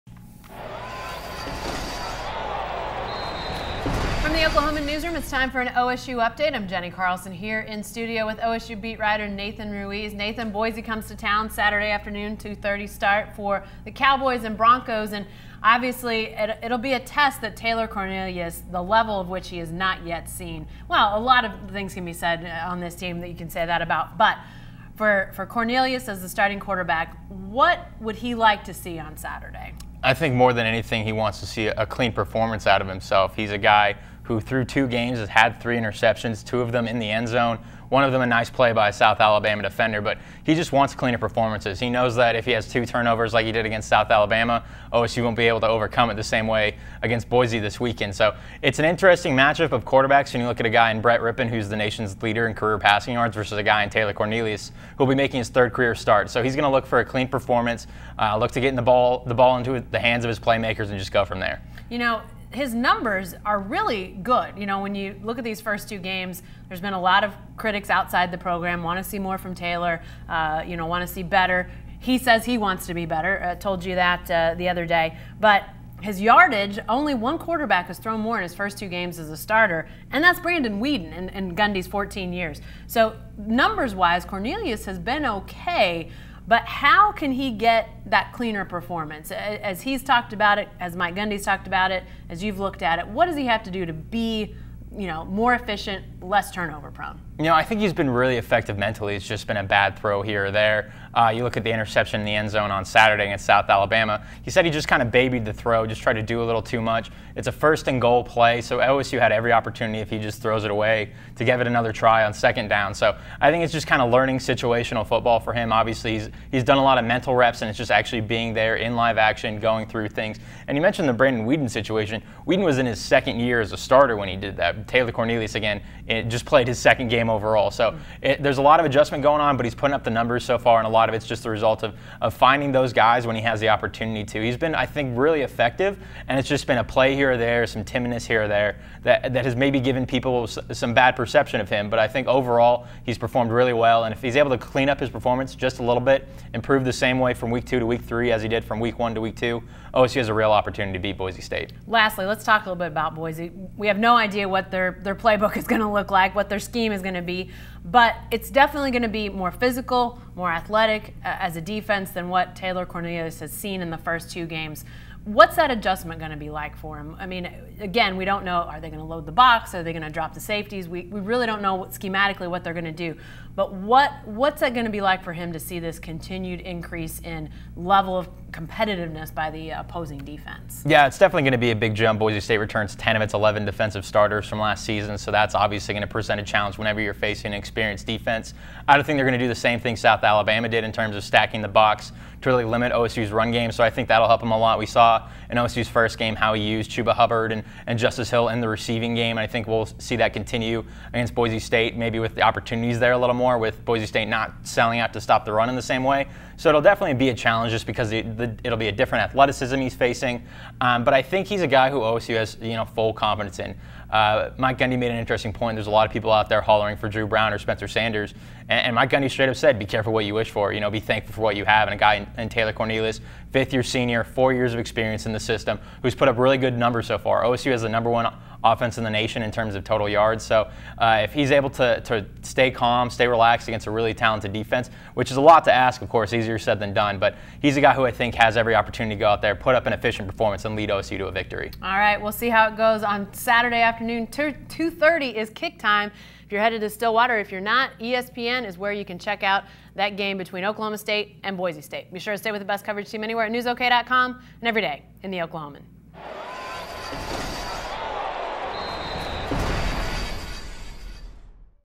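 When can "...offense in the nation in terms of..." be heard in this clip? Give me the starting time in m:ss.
3:48.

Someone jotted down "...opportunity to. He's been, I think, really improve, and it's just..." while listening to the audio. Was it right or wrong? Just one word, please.
wrong.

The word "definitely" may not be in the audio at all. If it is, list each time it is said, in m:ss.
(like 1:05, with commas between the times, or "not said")
2:38, 3:01, 3:26.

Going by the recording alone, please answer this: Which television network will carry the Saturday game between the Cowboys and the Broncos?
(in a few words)
ESPN.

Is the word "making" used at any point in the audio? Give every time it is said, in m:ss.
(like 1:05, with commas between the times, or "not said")
0:55.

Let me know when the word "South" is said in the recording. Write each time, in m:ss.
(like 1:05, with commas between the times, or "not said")
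0:38, 0:43, 1:43, 3:09.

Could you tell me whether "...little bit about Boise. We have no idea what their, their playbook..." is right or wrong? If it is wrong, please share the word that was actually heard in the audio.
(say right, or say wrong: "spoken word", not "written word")
right.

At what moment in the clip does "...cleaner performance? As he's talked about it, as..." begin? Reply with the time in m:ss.
1:28.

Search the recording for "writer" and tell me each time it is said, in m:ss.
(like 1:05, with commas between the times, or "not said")
0:08.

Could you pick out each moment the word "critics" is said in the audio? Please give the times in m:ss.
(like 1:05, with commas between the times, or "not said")
1:07.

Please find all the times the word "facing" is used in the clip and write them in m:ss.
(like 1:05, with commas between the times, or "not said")
3:07, 3:29.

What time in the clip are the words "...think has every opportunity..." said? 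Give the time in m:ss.
3:58.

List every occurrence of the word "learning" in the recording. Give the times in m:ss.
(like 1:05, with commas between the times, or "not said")
1:54.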